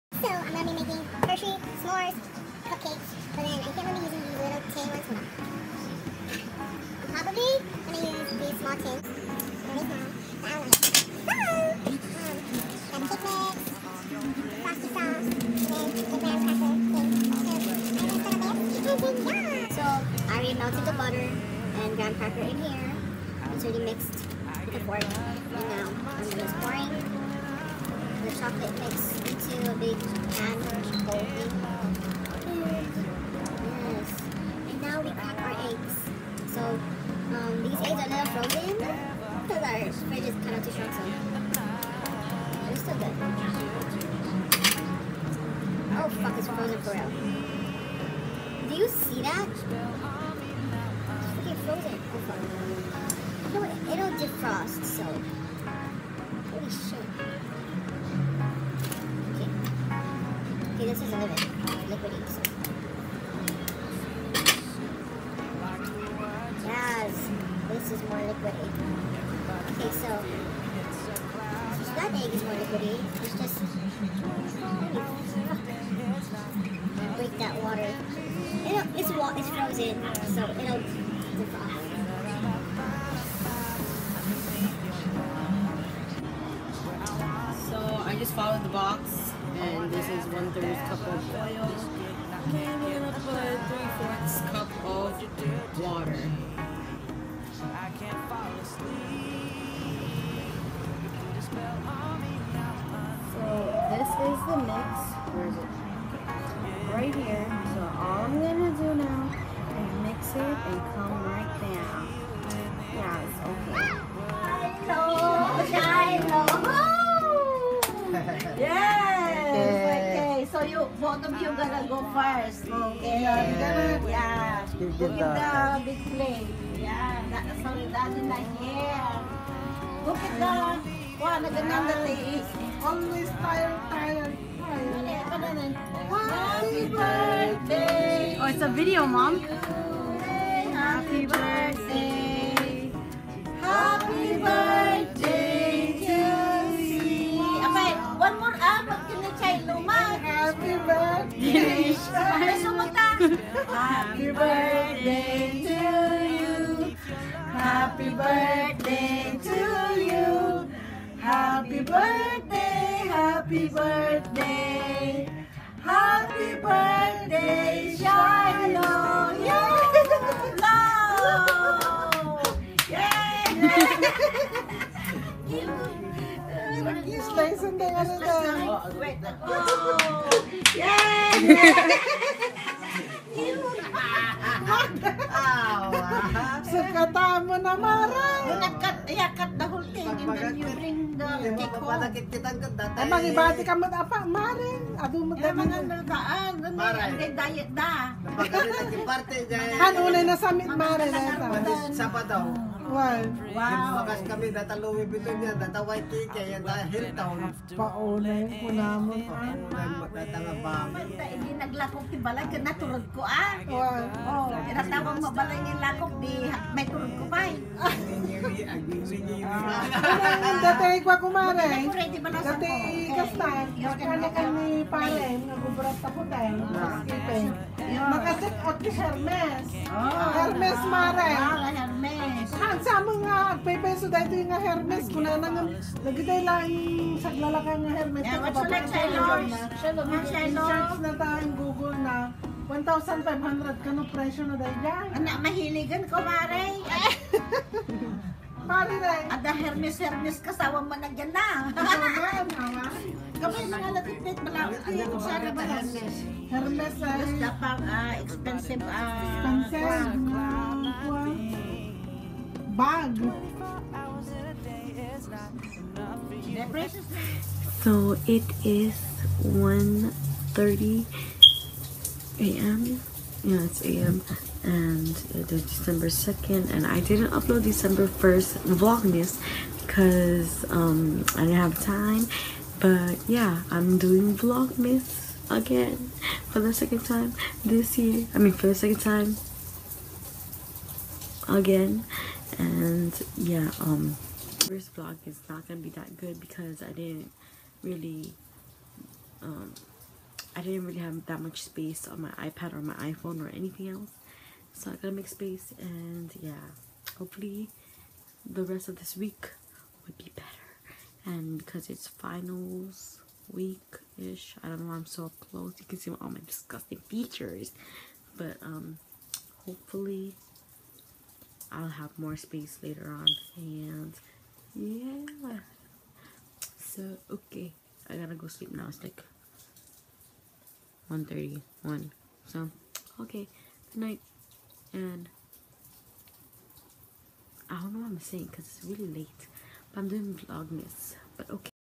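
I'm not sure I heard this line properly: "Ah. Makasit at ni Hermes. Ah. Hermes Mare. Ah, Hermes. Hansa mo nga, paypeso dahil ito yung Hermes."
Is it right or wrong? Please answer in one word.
right.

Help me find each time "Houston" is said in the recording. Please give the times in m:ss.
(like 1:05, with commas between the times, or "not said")
not said.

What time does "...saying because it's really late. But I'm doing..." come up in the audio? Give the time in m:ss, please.
5:38.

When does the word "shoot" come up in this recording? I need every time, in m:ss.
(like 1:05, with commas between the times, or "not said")
not said.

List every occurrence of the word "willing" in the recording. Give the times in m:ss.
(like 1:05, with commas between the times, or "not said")
not said.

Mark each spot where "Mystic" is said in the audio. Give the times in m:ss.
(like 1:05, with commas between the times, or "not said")
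not said.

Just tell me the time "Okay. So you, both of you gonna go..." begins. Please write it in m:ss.
1:59.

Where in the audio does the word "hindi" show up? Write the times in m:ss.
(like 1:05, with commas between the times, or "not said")
3:16, 3:31.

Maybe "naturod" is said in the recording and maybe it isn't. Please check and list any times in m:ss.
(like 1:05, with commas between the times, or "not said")
3:32.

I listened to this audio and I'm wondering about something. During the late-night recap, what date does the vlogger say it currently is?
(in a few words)
December 2nd.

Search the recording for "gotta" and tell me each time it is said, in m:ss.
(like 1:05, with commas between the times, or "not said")
5:04, 5:28.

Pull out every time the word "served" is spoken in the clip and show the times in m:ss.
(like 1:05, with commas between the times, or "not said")
not said.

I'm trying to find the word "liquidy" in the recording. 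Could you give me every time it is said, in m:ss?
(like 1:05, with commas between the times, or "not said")
1:01, 1:08, 1:12.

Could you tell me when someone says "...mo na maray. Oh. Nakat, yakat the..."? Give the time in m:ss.
3:07.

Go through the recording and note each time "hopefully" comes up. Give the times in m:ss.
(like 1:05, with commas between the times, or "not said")
5:07, 5:19.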